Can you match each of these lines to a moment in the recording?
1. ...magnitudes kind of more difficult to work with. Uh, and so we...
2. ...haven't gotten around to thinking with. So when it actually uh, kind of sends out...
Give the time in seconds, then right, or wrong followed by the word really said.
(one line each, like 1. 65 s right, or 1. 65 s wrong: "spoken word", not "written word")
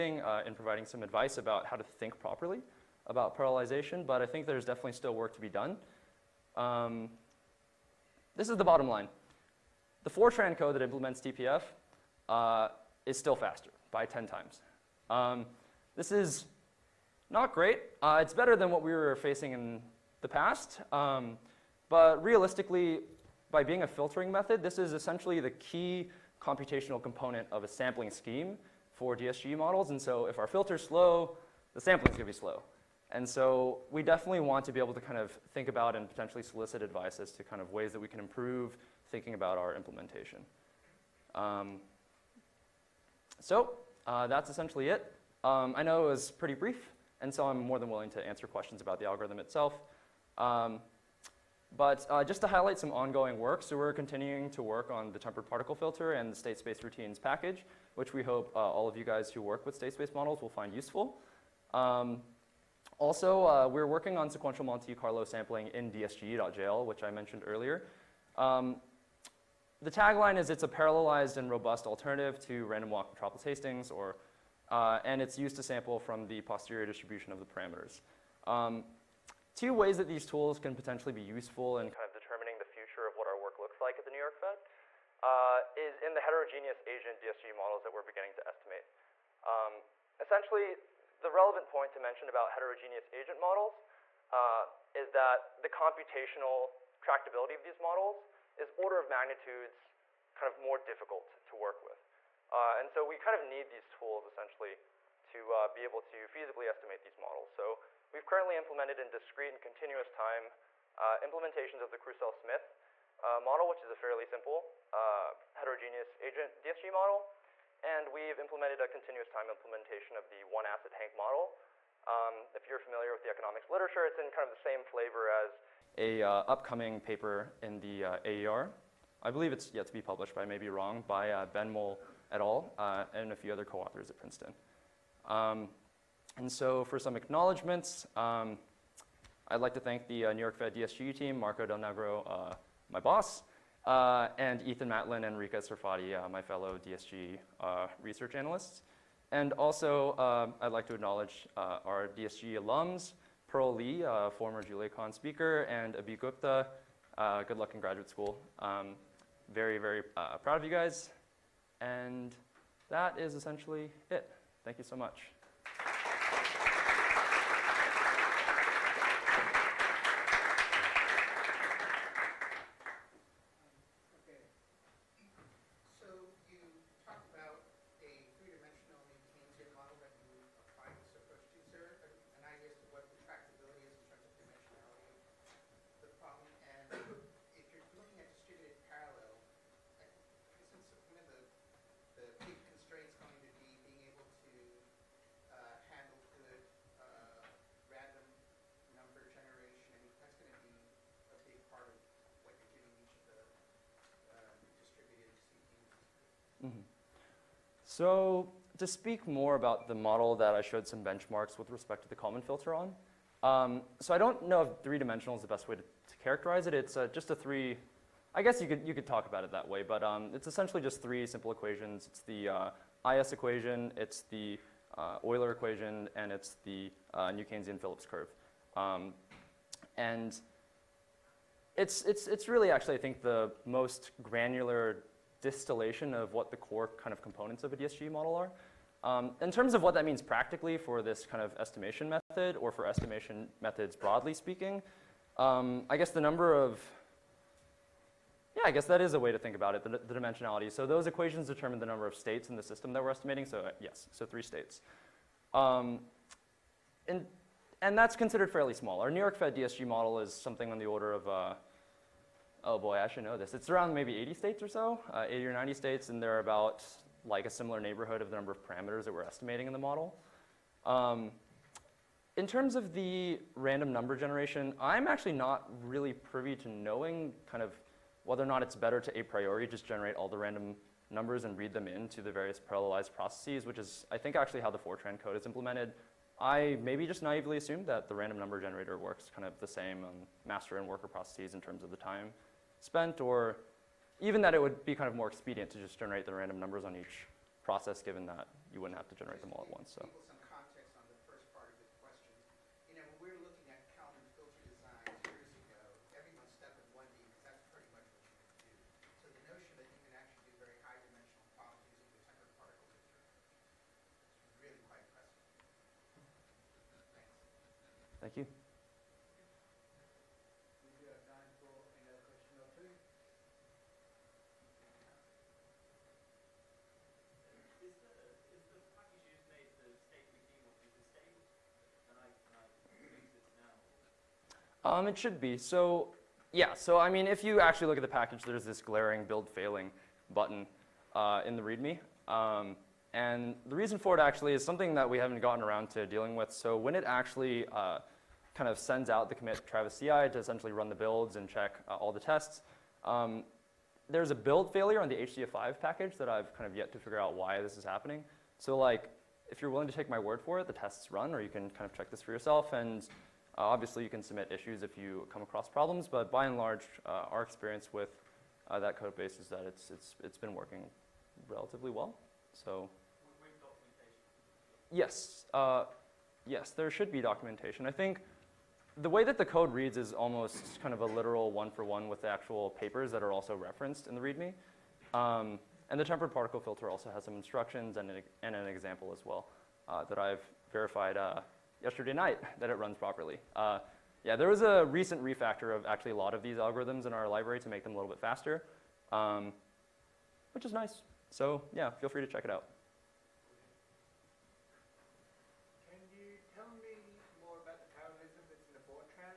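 1. 99 s right
2. 345 s wrong: "dealing", not "thinking".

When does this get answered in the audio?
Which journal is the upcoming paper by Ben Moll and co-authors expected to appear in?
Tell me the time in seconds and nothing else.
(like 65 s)
128 s.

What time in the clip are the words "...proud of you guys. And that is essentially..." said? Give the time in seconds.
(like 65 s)
160 s.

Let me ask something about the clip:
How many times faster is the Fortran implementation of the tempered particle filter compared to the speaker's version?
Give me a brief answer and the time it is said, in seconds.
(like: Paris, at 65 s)
10 times, at 14 s.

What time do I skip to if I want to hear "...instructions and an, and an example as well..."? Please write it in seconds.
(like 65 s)
387 s.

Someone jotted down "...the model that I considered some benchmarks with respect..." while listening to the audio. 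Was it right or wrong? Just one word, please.
wrong.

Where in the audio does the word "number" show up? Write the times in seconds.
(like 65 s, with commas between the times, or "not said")
246 s, 251 s, 268 s, 273 s, 281 s, 288 s.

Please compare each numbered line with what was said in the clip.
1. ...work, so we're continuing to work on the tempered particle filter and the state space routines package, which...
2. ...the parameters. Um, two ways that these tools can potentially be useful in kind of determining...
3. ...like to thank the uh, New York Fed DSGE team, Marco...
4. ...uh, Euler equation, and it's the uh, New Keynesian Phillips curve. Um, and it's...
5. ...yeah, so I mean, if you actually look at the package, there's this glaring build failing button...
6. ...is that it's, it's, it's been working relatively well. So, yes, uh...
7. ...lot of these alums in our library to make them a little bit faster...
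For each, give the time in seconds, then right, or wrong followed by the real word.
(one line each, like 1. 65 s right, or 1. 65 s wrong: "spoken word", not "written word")
1. 53 s right
2. 77 s right
3. 139 s right
4. 224 s right
5. 336 s right
6. 369 s right
7. 396 s wrong: "algorithms", not "alums".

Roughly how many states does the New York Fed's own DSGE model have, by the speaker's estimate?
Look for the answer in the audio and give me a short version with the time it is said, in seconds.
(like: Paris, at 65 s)
80 or 90, at 265 s.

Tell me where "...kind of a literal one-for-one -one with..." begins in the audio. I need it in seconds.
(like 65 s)
380 s.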